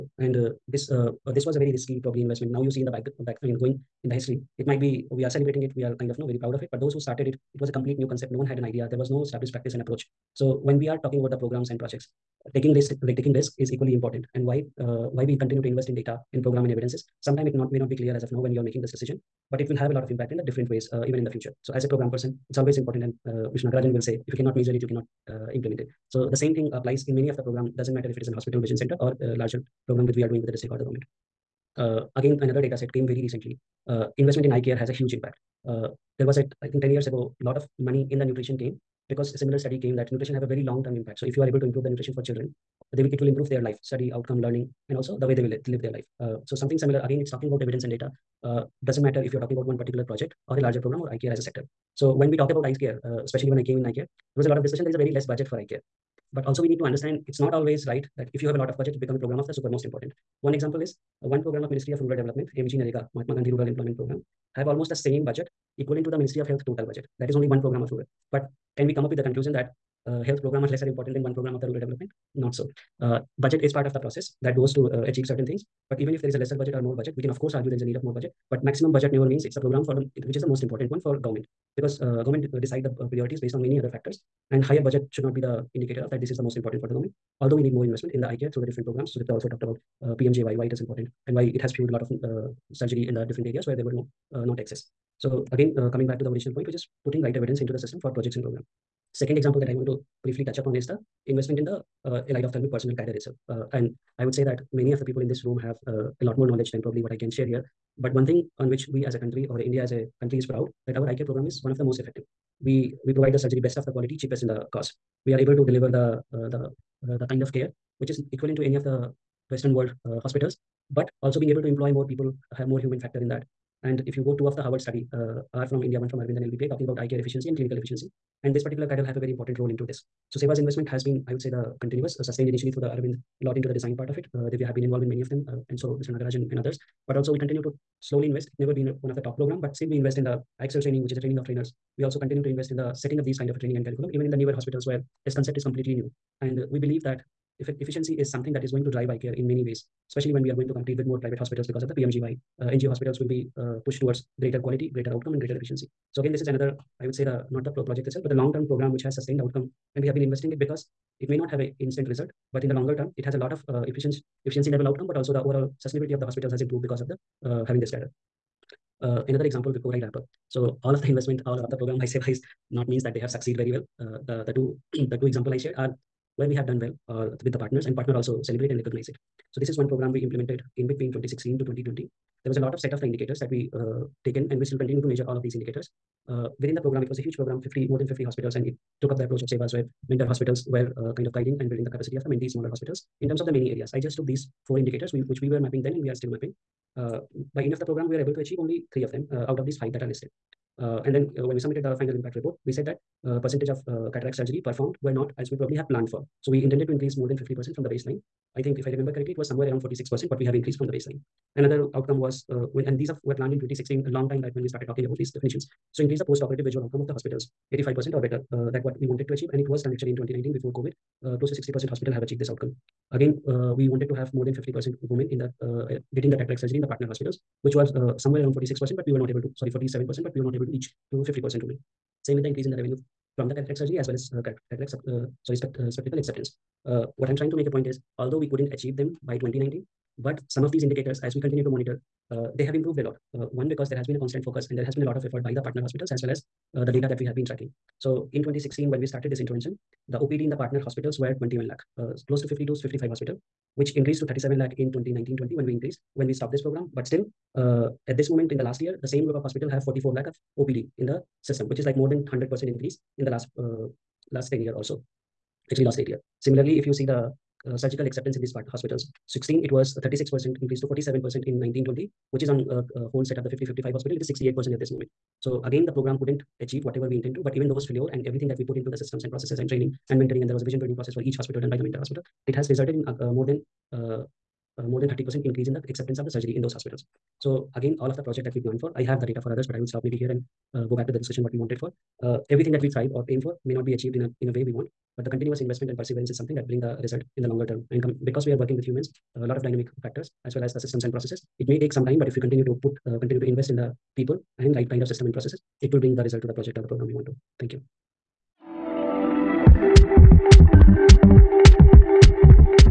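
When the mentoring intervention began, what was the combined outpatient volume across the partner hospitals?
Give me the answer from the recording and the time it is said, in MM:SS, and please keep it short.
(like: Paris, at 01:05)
21 lakh, at 04:11.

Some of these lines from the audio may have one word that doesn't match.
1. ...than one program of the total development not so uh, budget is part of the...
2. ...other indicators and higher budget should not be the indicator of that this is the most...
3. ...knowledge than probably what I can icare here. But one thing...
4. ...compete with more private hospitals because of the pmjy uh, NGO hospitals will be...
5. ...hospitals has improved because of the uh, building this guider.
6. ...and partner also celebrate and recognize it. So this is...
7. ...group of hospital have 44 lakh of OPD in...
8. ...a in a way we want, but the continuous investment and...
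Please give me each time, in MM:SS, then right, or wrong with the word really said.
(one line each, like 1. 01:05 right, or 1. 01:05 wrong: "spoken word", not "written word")
1. 01:11 wrong: "rural", not "total"
2. 01:23 wrong: "factors", not "indicators"
3. 01:46 wrong: "share", not "icare"
4. 02:30 right
5. 02:46 wrong: "having", not "building"
6. 02:57 right
7. 04:19 right
8. 04:54 right.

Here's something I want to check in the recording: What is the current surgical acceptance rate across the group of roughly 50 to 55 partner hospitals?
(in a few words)
68%.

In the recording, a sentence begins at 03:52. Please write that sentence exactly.
Same with the increase in the revenue from the cataract surgery as well as uh, cataract, uh, sorry, spect, uh, spectacle acceptance.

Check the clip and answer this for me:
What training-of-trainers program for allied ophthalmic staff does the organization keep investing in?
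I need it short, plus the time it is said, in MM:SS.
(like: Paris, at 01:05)
excel training, at 02:20.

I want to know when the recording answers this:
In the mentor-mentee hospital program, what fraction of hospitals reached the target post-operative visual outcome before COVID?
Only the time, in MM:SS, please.
03:41.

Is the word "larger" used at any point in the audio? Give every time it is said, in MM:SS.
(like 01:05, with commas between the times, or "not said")
00:29, 00:50.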